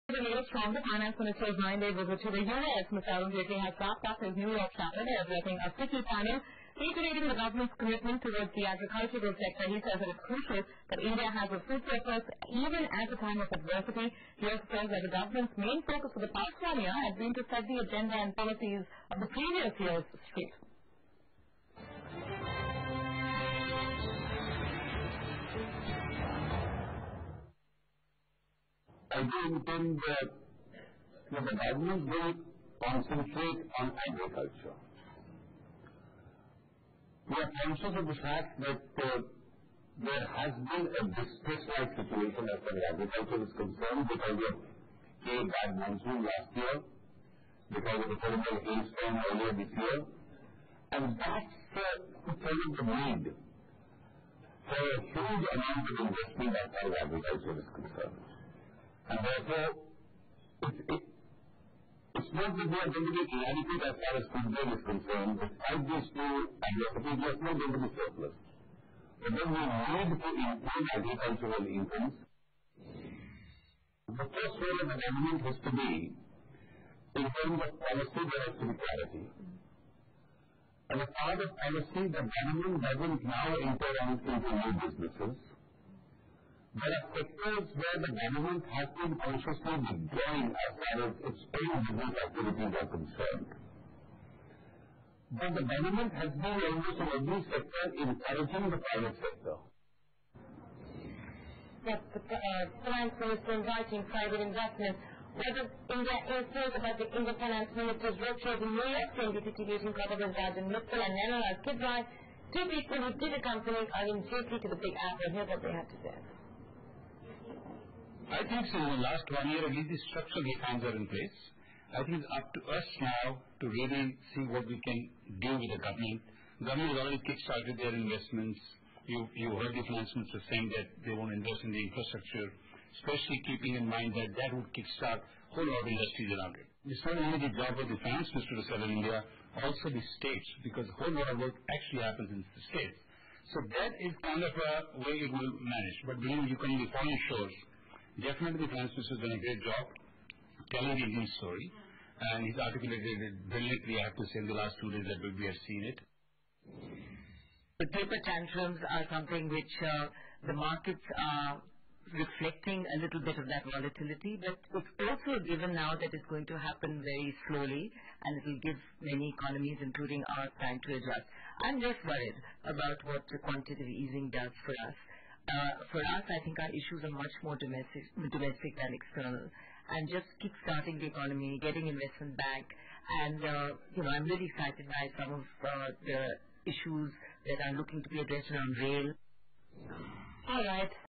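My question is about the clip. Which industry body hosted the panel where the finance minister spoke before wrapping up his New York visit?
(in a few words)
FICCI.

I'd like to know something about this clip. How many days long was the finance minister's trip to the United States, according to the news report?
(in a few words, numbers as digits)
9.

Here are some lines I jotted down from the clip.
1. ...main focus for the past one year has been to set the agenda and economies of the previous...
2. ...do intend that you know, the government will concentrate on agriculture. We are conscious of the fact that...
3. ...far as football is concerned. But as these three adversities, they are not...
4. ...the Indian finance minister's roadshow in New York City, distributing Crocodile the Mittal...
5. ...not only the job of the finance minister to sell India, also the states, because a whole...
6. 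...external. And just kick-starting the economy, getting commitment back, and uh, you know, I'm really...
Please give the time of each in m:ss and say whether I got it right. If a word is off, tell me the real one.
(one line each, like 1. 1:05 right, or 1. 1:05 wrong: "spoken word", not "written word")
1. 0:15 wrong: "policies", not "economies"
2. 0:29 right
3. 1:03 wrong: "two", not "three"
4. 1:46 right
5. 2:17 right
6. 2:58 wrong: "investment", not "commitment".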